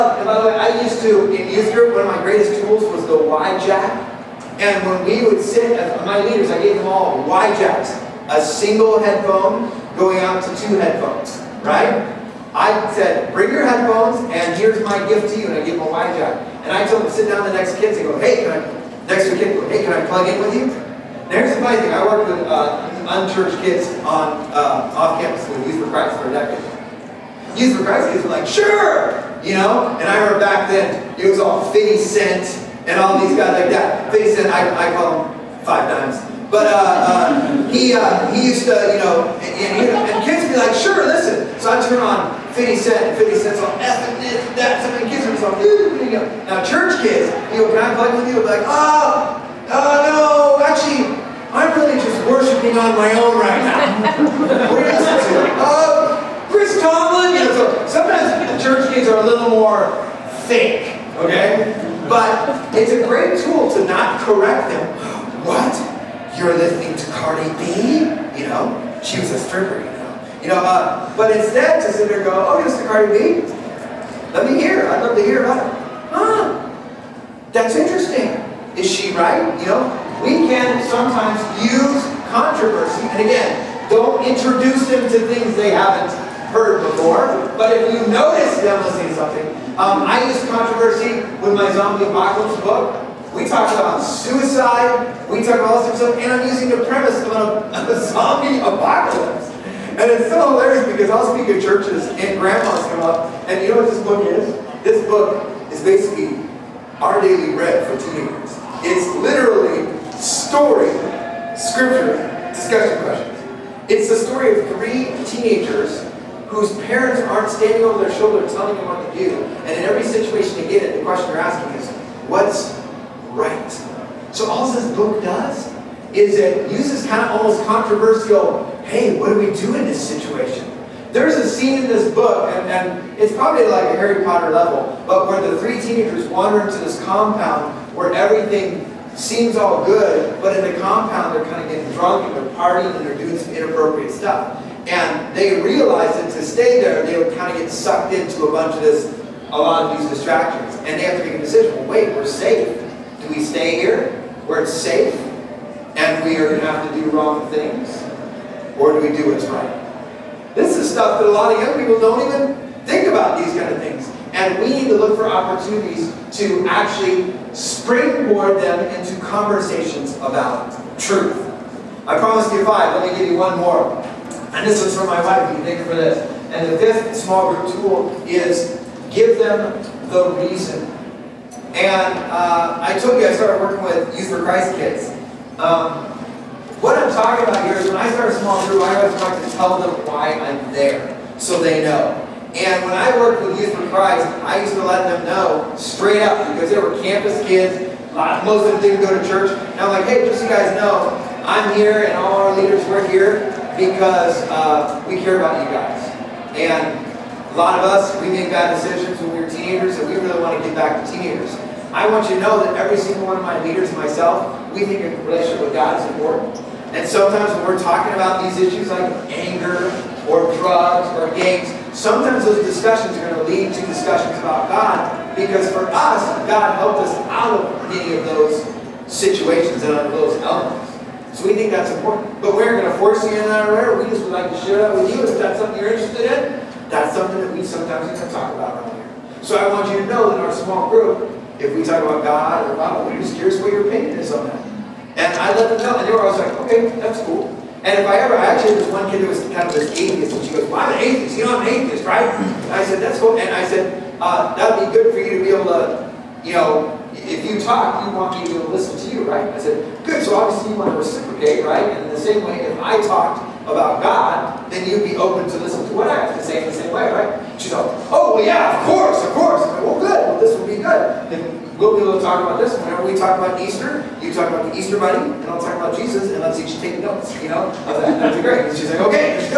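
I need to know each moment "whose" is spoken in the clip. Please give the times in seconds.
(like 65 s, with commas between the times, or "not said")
116 s.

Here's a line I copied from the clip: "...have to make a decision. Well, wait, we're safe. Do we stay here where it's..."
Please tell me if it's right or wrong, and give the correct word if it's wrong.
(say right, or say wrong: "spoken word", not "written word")
right.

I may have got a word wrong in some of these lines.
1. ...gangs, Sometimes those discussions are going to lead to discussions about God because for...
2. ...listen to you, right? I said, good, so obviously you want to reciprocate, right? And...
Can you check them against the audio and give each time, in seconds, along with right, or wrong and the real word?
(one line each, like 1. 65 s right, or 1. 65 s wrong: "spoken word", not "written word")
1. 221 s right
2. 258 s right.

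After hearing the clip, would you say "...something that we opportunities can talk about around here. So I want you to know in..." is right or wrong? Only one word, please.
wrong.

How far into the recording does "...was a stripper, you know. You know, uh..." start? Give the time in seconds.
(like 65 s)
69 s.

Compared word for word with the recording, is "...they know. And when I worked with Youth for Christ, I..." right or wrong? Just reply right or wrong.
right.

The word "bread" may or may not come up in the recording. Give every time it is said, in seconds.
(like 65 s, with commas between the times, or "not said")
107 s.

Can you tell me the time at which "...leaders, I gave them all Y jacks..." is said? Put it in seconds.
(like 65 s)
6 s.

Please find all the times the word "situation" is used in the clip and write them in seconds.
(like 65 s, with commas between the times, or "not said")
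120 s, 130 s, 229 s.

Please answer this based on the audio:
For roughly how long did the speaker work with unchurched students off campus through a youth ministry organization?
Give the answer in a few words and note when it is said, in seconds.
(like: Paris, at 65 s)
a decade, at 26 s.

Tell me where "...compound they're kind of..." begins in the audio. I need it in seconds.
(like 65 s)
140 s.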